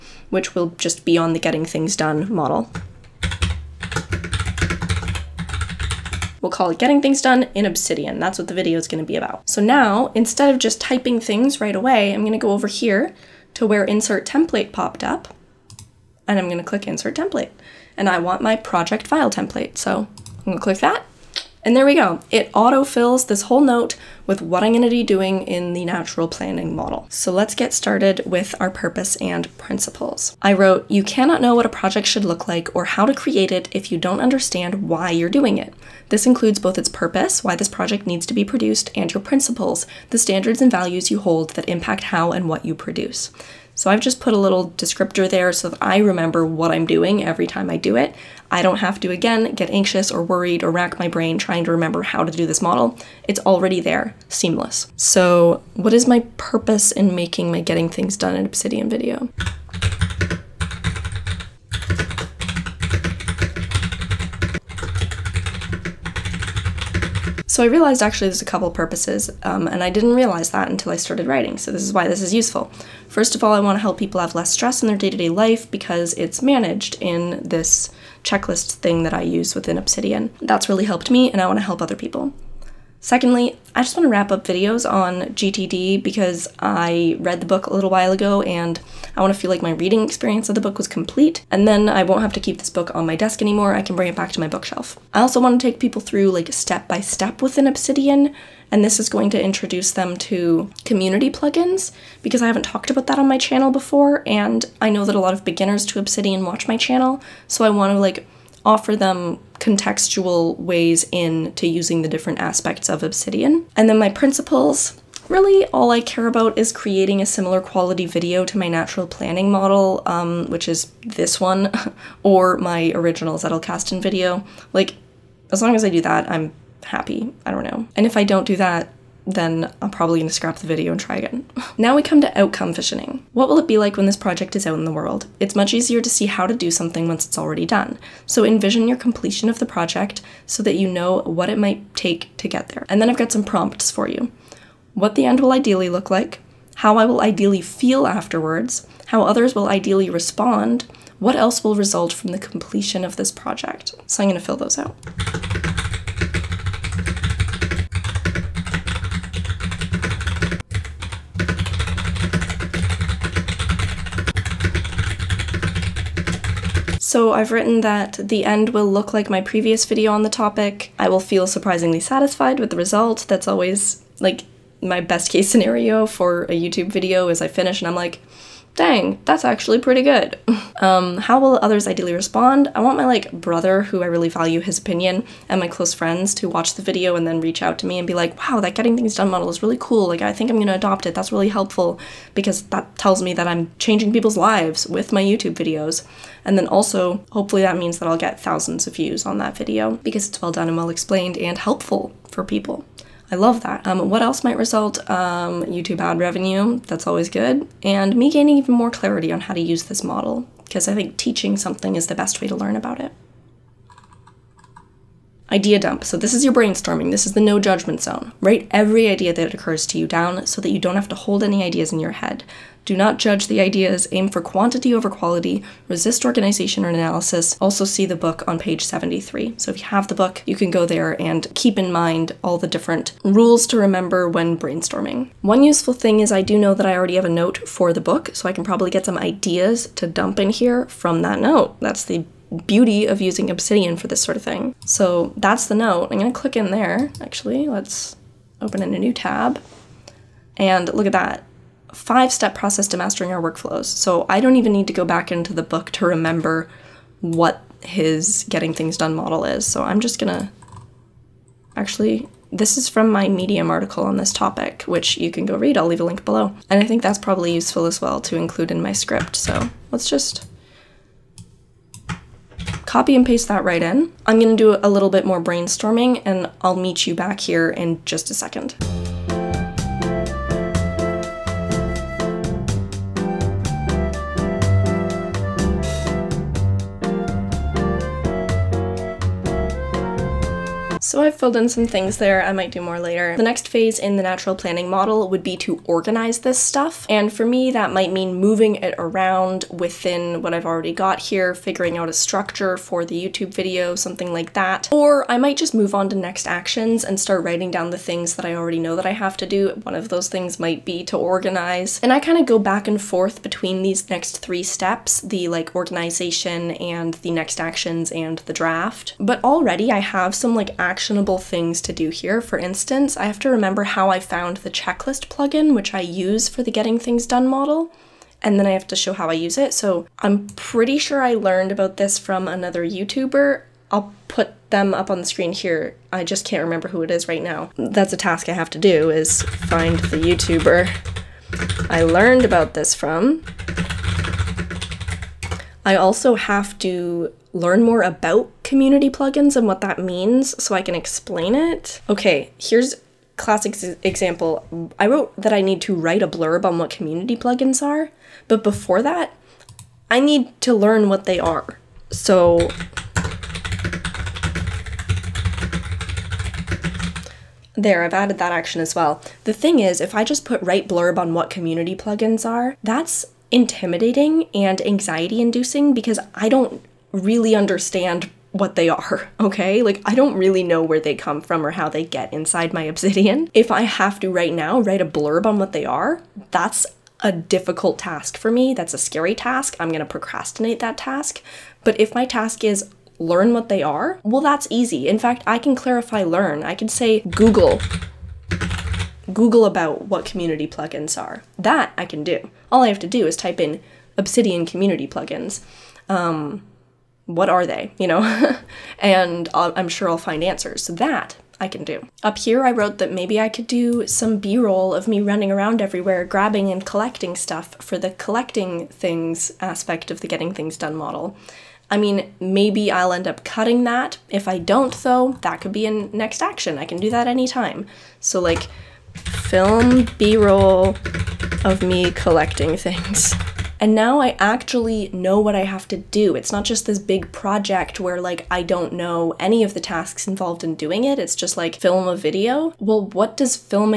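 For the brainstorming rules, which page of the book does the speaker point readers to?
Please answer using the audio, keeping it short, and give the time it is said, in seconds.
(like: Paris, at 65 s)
73, at 228 s.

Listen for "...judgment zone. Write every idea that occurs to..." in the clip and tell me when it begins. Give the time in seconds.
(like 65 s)
217 s.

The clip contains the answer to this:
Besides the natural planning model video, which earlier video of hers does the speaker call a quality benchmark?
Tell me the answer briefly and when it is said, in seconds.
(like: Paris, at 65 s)
Zettelkasten video, at 123 s.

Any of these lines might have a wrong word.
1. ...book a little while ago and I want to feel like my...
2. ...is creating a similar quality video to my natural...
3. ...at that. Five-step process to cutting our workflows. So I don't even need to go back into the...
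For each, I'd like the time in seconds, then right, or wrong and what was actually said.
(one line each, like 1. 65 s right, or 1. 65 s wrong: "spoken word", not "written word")
1. 87 s right
2. 116 s right
3. 251 s wrong: "mastering", not "cutting".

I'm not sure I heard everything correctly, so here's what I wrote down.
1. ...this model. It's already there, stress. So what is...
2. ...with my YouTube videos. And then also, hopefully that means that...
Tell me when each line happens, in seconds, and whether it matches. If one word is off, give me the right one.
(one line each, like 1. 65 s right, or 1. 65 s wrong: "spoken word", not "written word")
1. 52 s wrong: "seamless", not "stress"
2. 194 s right.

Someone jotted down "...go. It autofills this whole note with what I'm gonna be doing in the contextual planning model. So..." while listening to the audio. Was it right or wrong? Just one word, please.
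wrong.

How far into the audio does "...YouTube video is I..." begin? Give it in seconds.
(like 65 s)
176 s.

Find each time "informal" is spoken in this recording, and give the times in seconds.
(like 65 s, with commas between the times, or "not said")
not said.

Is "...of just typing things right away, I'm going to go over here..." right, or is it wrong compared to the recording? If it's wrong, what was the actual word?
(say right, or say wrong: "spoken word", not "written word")
right.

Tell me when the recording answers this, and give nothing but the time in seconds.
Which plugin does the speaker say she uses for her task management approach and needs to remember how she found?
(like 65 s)
324 s.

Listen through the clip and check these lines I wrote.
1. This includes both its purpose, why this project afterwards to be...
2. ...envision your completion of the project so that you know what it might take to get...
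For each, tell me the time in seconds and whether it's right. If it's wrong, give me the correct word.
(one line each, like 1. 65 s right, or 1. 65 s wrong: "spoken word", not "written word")
1. 36 s wrong: "needs", not "afterwards"
2. 138 s right.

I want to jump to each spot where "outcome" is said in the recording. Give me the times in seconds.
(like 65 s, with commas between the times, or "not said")
132 s.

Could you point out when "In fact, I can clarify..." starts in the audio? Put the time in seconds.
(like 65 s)
395 s.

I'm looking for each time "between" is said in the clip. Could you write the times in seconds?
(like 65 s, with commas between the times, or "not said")
313 s.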